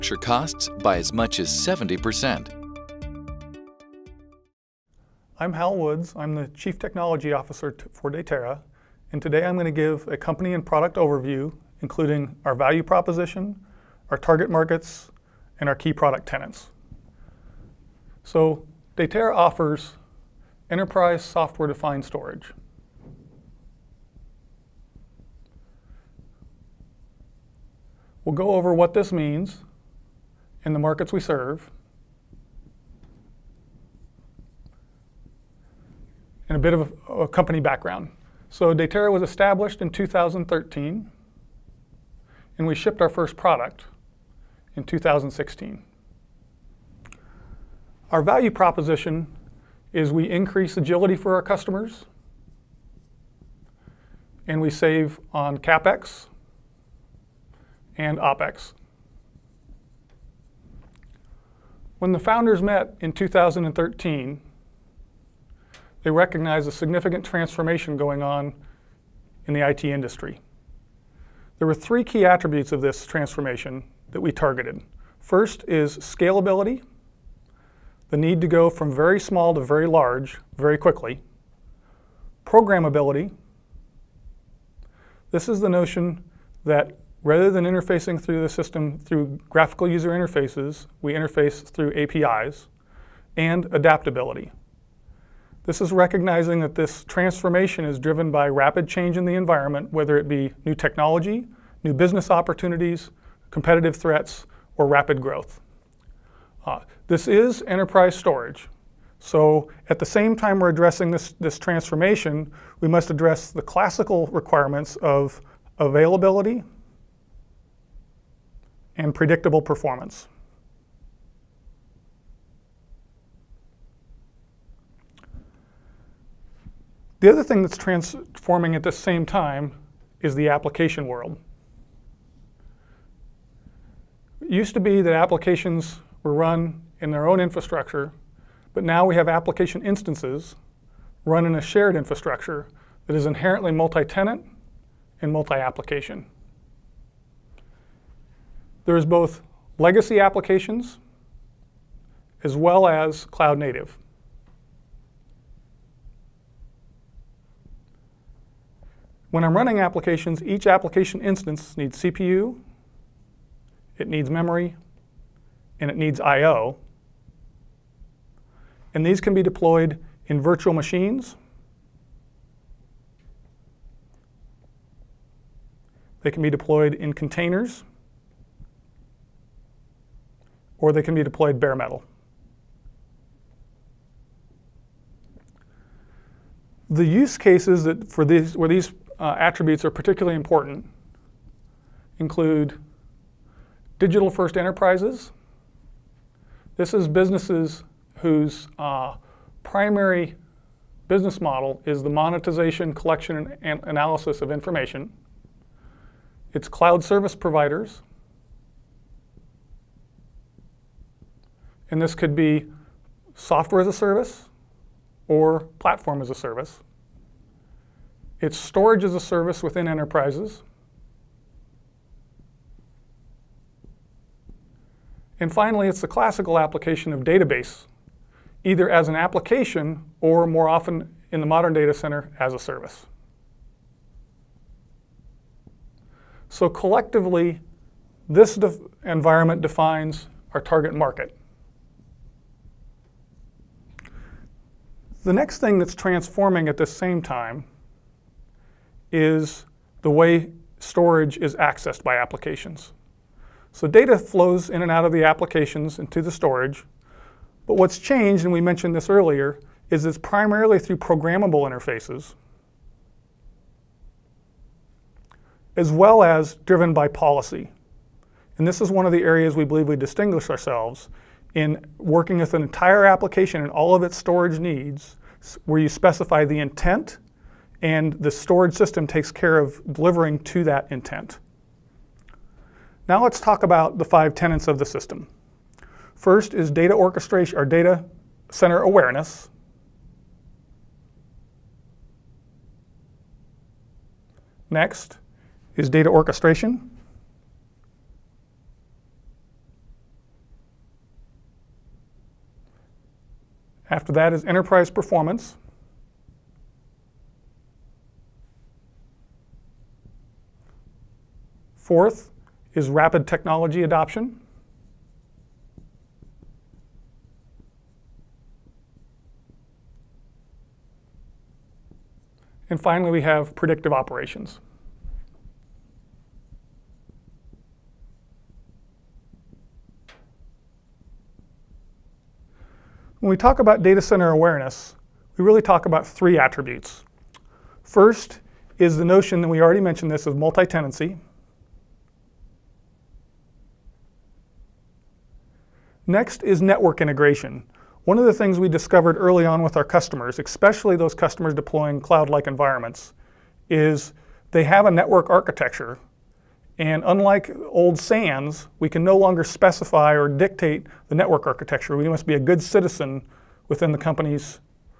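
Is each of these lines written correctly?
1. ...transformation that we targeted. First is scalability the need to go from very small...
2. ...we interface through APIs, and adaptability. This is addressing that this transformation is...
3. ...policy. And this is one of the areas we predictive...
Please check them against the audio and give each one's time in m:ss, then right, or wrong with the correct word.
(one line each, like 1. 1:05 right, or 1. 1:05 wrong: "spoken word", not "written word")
1. 1:13 right
2. 1:31 wrong: "recognizing", not "addressing"
3. 4:27 wrong: "believe", not "predictive".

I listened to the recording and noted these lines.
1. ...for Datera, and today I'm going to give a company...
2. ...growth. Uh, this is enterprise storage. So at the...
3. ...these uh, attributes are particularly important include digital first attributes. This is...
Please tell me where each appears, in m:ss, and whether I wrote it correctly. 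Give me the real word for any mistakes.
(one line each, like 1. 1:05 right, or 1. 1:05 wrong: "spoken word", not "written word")
1. 0:07 right
2. 1:45 right
3. 3:08 wrong: "enterprises", not "attributes".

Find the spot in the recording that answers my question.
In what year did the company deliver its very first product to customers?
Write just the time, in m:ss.
0:44.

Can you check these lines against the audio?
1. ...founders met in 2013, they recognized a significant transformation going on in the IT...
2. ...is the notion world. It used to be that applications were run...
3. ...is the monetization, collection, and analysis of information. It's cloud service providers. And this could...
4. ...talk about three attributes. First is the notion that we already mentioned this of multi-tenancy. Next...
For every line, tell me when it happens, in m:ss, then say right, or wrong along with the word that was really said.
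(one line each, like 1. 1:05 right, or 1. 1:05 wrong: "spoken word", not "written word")
1. 1:02 right
2. 2:10 wrong: "application", not "notion"
3. 3:21 right
4. 5:35 right.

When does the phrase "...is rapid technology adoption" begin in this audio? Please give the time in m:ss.
5:12.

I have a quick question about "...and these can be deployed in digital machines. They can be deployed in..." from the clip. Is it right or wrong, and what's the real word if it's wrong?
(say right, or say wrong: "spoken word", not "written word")
wrong: "virtual", not "digital".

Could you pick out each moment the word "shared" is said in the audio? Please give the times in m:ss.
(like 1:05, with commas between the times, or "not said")
2:21.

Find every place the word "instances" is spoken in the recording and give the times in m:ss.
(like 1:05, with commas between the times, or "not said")
2:19, 2:41.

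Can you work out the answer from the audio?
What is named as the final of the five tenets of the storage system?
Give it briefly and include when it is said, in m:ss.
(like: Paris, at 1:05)
predictive operations, at 5:23.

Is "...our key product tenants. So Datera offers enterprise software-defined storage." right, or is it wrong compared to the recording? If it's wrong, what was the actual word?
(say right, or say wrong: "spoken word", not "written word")
right.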